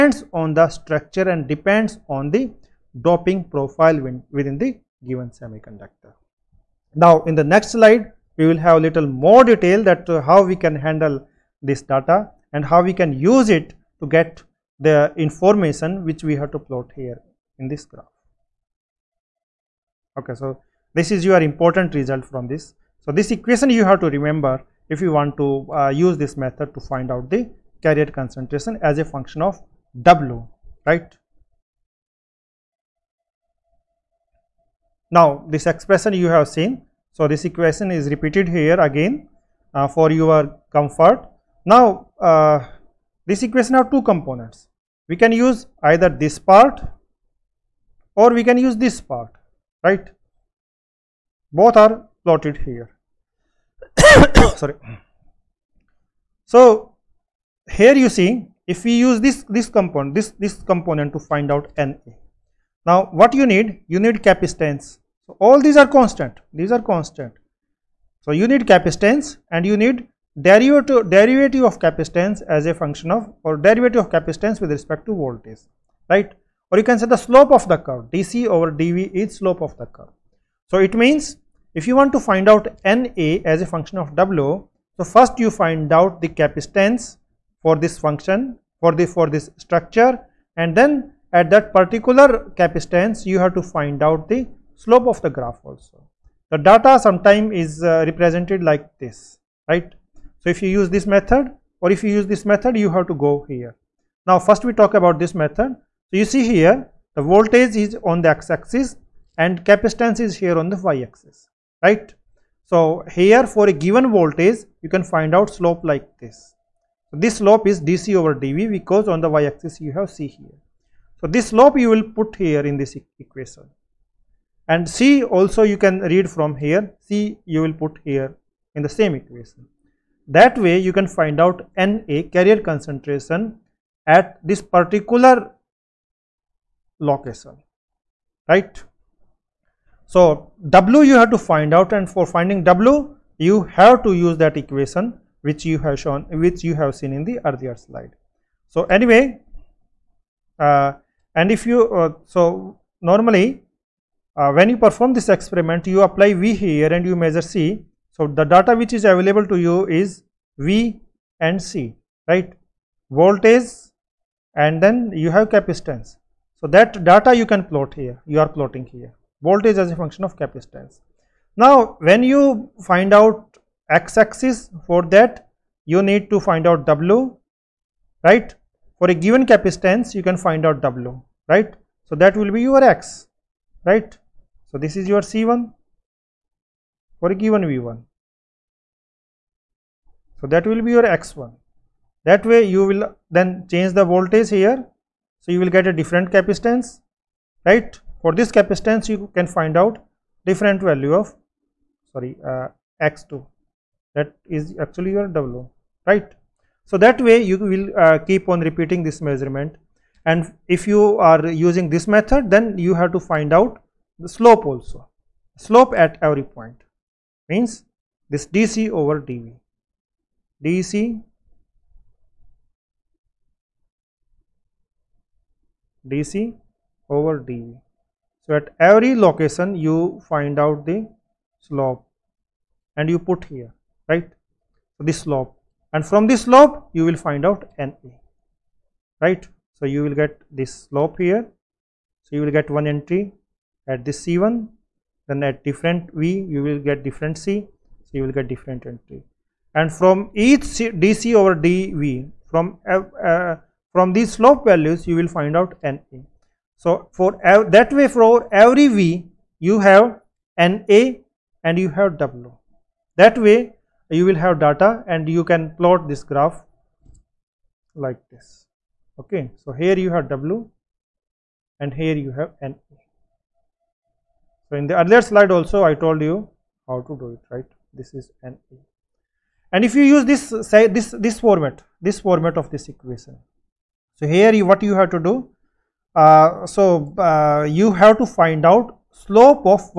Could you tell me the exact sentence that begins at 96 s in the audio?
The data sometime is uh, represented like this, right?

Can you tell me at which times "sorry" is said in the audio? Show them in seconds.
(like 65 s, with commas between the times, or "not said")
54 s, 202 s.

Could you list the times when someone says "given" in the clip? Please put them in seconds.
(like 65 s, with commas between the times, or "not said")
5 s, 113 s, 179 s, 187 s.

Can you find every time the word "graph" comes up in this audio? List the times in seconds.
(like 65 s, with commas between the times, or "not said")
17 s, 95 s, 266 s.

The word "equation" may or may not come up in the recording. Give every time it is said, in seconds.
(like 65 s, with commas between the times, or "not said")
23 s, 37 s, 43 s, 123 s, 129 s, 144 s, 282 s.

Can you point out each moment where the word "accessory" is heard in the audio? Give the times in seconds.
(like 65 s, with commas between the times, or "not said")
not said.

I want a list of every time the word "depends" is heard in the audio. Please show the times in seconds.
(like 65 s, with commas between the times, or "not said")
1 s.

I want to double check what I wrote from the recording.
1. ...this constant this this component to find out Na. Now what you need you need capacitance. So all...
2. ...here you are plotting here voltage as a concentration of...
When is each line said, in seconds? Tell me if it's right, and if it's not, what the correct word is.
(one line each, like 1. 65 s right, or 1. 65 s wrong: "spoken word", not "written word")
1. 59 s wrong: "component", not "constant"
2. 167 s wrong: "function", not "concentration".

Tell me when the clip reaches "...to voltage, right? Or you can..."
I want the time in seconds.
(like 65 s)
75 s.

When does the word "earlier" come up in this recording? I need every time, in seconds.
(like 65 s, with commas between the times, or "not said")
147 s, 275 s.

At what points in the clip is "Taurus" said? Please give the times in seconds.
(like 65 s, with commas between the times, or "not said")
not said.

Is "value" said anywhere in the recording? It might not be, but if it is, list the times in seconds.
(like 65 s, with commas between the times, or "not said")
200 s, 254 s.